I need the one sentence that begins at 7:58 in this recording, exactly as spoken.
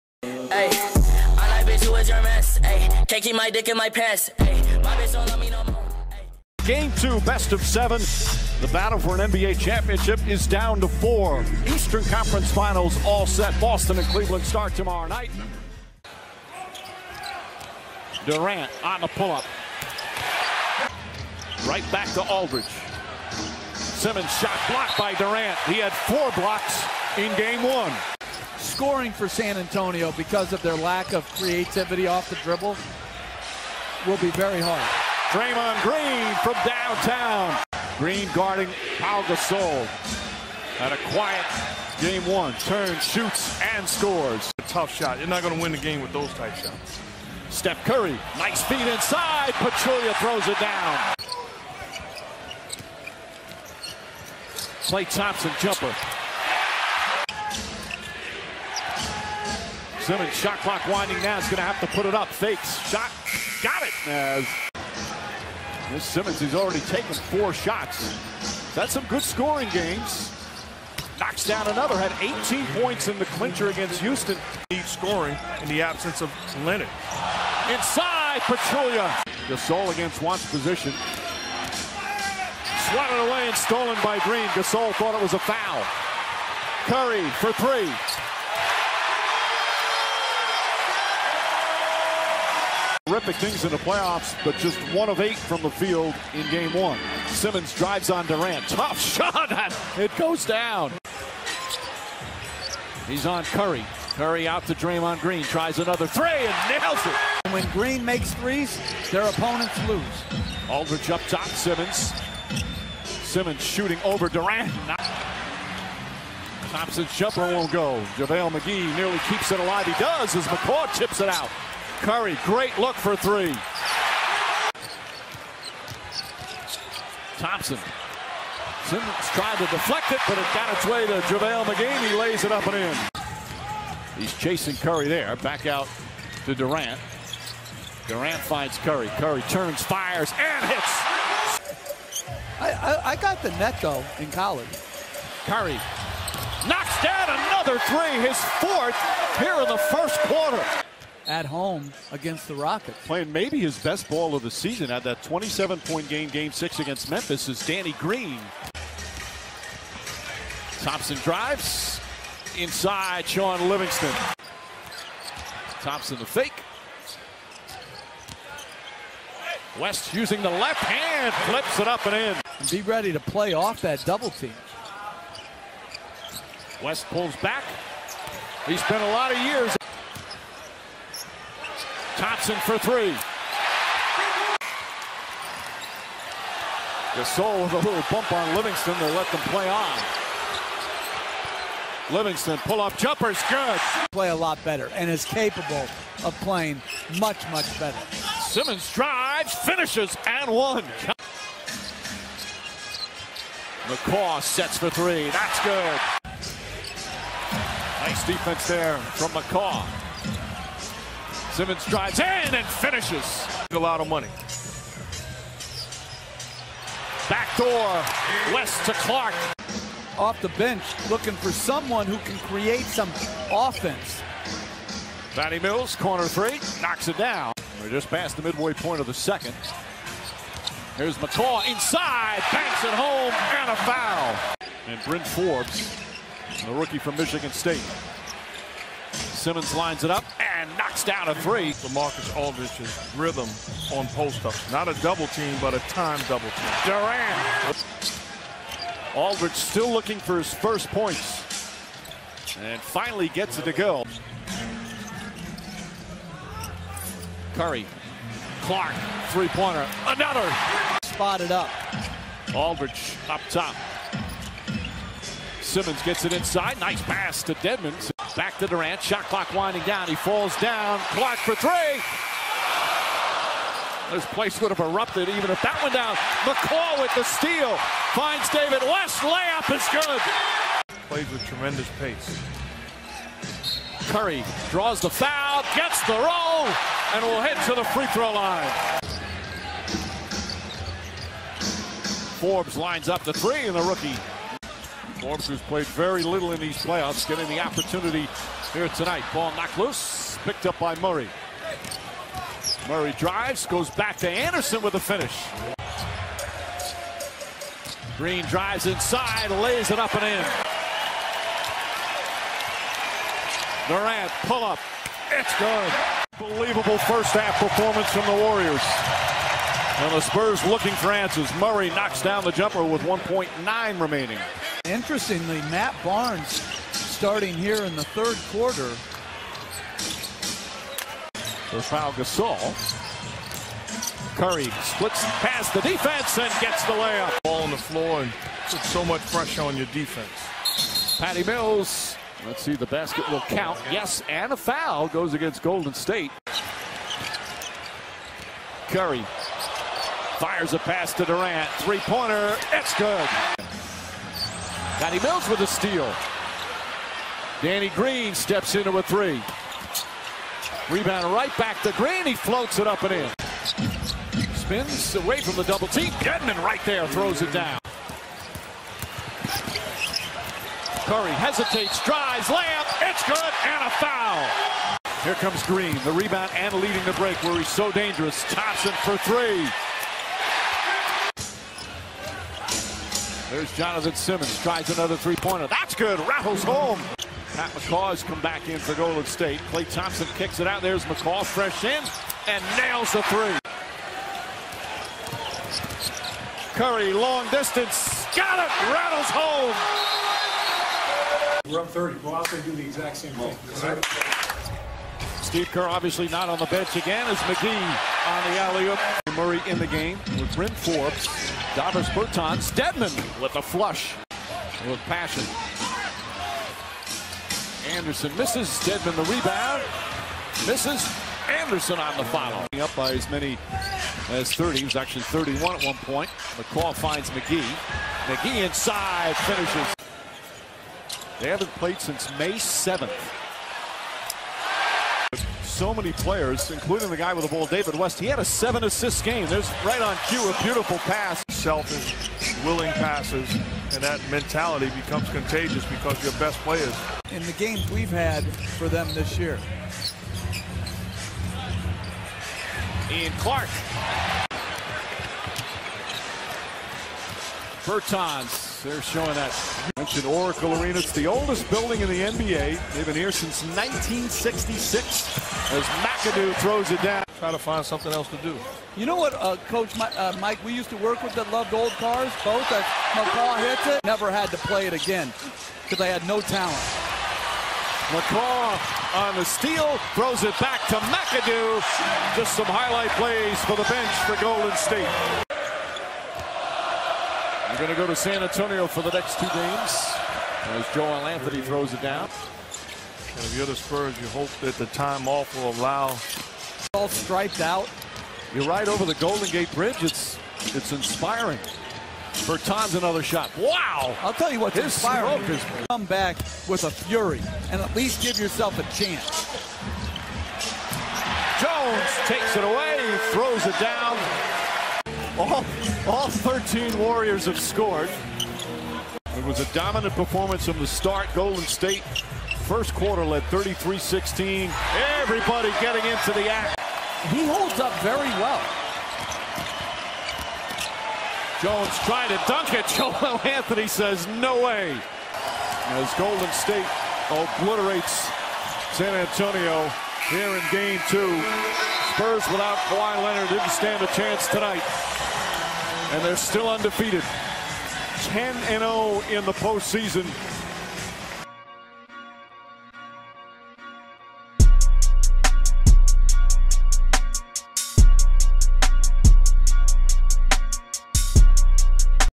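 McCaw on the steal, throws it back to McAdoo.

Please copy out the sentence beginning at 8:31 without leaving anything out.
Jones takes it away, throws it down.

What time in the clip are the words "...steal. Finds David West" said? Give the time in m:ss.
4:37.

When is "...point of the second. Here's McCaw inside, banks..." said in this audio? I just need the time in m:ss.
3:48.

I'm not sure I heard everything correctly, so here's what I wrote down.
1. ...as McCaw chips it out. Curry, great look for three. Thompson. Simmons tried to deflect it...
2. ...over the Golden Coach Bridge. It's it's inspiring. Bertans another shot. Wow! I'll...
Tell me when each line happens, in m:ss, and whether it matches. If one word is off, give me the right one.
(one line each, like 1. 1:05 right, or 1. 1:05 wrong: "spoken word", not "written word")
1. 2:00 right
2. 8:18 wrong: "Gate", not "Coach".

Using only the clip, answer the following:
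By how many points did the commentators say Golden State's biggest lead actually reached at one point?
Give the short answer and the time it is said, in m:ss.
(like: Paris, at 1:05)
31, at 7:05.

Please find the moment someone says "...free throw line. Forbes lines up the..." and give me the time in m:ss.
4:47.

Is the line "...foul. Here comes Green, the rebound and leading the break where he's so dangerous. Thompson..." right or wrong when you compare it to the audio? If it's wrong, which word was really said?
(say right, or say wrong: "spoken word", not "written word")
right.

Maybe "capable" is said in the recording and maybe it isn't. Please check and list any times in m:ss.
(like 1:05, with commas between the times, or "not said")
3:15.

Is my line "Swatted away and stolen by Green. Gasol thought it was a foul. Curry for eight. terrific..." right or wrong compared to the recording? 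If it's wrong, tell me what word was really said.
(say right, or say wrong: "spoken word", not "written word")
wrong: "three", not "eight".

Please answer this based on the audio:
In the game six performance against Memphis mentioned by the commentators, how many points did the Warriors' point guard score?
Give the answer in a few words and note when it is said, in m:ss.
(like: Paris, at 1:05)
27, at 2:35.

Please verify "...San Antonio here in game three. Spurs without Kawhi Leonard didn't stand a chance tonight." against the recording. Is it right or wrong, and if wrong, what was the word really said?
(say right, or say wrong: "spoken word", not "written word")
wrong: "two", not "three".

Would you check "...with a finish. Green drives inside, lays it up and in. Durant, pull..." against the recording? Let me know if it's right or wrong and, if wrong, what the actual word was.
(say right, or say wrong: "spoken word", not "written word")
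right.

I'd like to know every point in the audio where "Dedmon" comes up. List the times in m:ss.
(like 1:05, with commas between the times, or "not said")
4:27, 6:52, 6:58.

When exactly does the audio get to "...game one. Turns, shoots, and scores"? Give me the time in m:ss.
0:42.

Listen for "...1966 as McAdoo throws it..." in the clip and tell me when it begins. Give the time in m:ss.
7:43.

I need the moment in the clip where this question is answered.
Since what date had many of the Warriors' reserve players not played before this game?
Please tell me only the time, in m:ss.
7:12.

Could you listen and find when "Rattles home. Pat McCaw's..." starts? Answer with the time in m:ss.
6:26.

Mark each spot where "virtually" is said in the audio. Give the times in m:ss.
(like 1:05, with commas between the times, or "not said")
not said.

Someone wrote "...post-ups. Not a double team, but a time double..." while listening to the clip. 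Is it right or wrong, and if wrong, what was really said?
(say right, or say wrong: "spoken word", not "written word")
right.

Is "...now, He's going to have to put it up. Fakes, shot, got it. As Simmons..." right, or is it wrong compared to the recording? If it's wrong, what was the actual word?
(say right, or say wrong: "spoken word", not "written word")
right.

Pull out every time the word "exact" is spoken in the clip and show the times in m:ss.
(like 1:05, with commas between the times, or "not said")
6:42.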